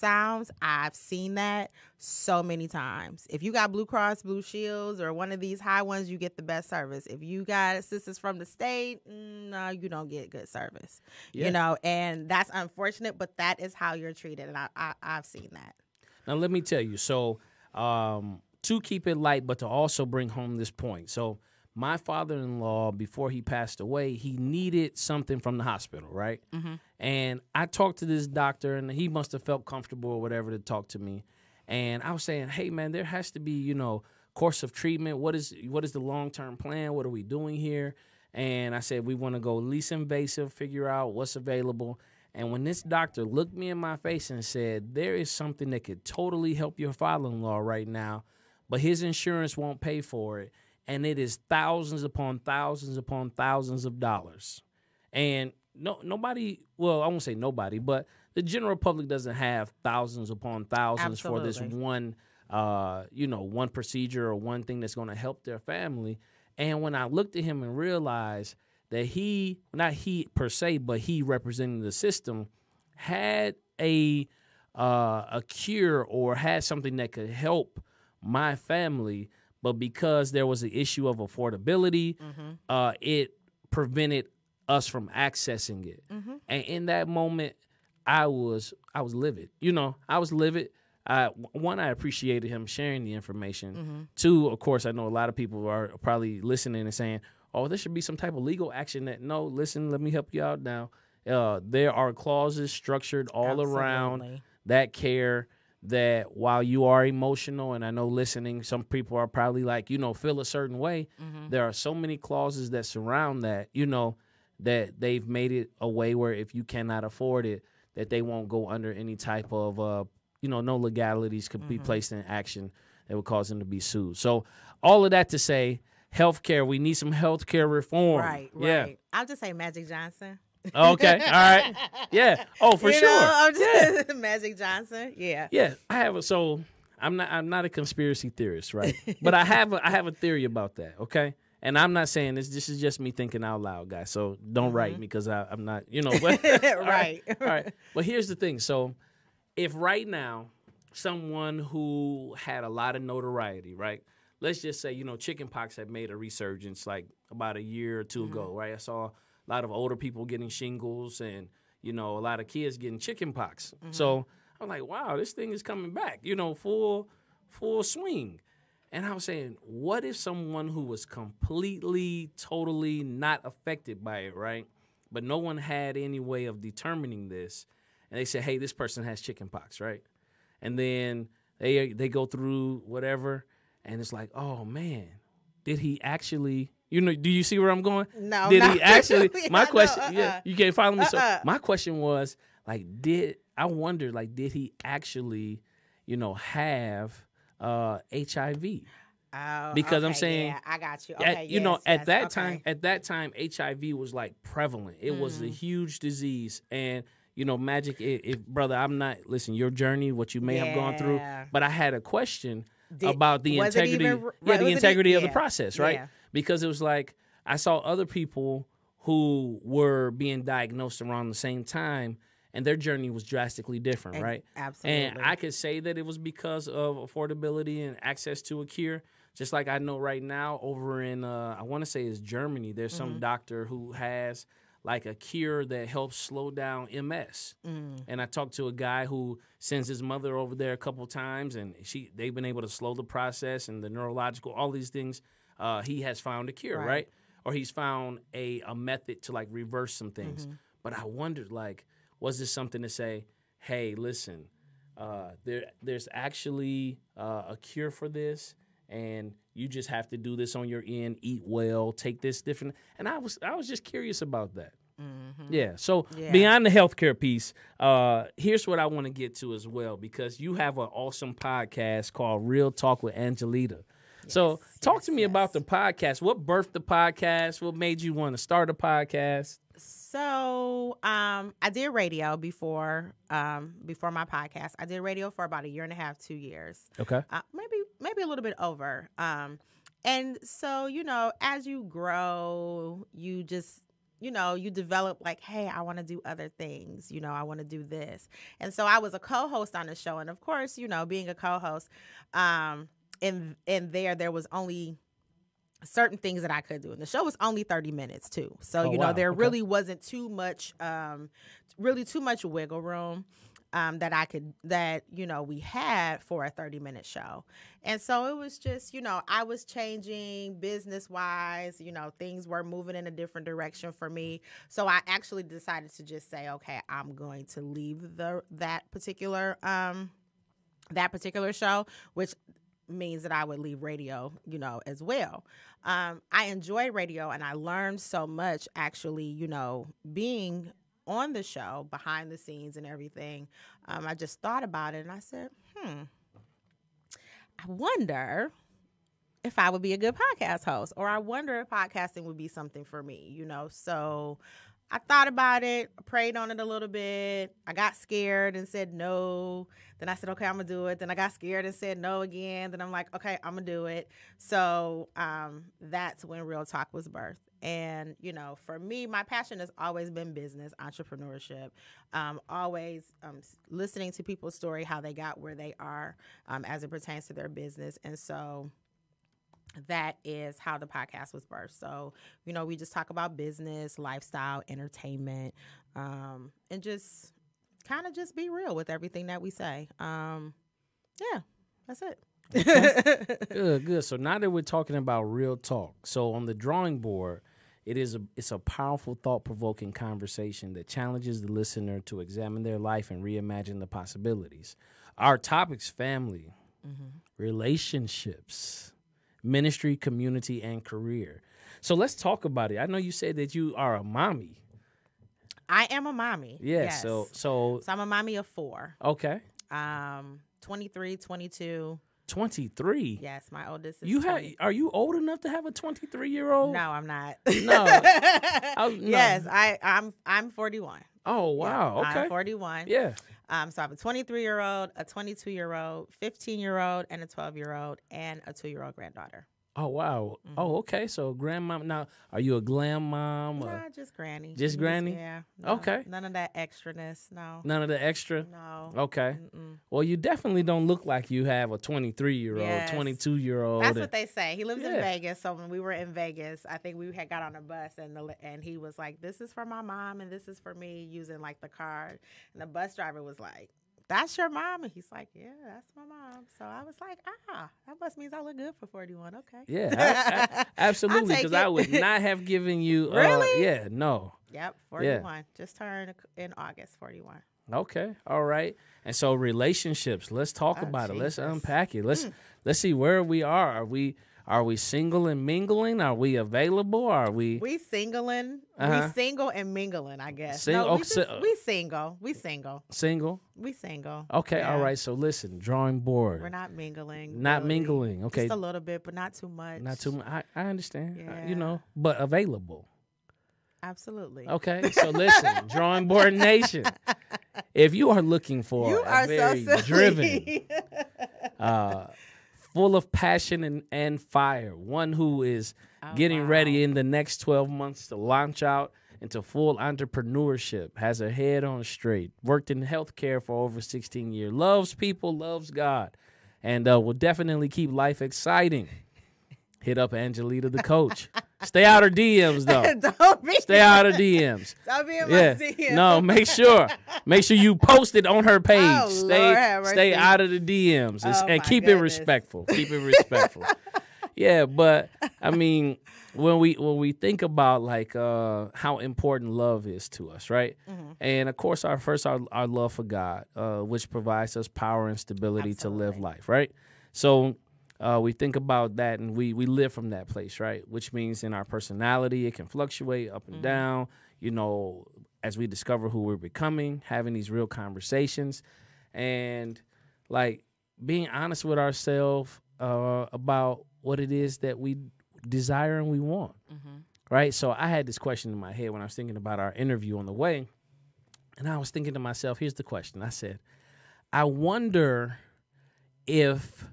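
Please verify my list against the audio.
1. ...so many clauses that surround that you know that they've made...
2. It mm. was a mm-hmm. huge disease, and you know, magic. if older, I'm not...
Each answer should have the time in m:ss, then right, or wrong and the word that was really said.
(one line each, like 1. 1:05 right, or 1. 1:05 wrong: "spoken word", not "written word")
1. 1:51 right
2. 3:25 wrong: "brother", not "older".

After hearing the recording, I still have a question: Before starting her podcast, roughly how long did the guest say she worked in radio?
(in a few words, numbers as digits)
A year and a half.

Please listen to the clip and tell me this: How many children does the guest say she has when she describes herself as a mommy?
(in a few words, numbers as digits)
4.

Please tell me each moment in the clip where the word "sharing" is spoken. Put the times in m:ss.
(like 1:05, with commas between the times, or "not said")
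1:32.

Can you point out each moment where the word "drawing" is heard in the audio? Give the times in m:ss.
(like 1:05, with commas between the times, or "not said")
6:36, 8:15, 8:25.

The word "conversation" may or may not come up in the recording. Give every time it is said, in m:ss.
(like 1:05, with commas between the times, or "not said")
6:39, 9:27.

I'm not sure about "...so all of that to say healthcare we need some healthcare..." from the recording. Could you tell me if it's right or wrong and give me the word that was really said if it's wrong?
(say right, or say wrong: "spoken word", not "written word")
right.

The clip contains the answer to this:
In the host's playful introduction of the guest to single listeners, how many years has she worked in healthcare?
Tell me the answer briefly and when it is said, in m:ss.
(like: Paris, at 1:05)
16 years, at 8:43.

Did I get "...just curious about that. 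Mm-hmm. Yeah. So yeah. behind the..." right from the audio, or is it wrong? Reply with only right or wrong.
wrong.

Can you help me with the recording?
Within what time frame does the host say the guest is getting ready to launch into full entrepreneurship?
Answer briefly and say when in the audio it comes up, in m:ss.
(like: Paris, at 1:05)
12 months, at 8:37.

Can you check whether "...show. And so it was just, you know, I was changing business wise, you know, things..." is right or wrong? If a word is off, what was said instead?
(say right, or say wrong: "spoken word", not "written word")
right.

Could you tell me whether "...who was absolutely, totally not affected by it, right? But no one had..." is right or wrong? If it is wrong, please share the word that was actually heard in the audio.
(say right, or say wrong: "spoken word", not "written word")
wrong: "completely", not "absolutely".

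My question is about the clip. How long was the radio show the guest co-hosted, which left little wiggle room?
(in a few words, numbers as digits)
30 minutes.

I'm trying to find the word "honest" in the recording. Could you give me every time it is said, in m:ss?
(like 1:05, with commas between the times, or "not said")
9:31.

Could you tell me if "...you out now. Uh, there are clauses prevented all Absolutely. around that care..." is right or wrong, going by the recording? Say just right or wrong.
wrong.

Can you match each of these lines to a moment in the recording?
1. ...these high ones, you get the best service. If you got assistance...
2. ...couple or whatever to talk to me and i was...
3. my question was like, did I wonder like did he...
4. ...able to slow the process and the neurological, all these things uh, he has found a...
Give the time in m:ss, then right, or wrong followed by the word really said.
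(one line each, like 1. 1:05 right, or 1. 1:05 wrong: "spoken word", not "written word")
1. 0:05 right
2. 0:29 wrong: "comfortable", not "couple"
3. 3:11 right
4. 4:02 right.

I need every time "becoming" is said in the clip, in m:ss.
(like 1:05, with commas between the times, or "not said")
9:26.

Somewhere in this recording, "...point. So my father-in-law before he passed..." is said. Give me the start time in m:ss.
0:20.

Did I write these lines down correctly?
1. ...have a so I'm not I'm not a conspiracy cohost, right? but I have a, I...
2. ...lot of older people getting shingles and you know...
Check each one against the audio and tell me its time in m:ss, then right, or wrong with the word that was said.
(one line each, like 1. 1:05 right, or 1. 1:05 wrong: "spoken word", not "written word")
1. 2:15 wrong: "theorist", not "cohost"
2. 2:39 right.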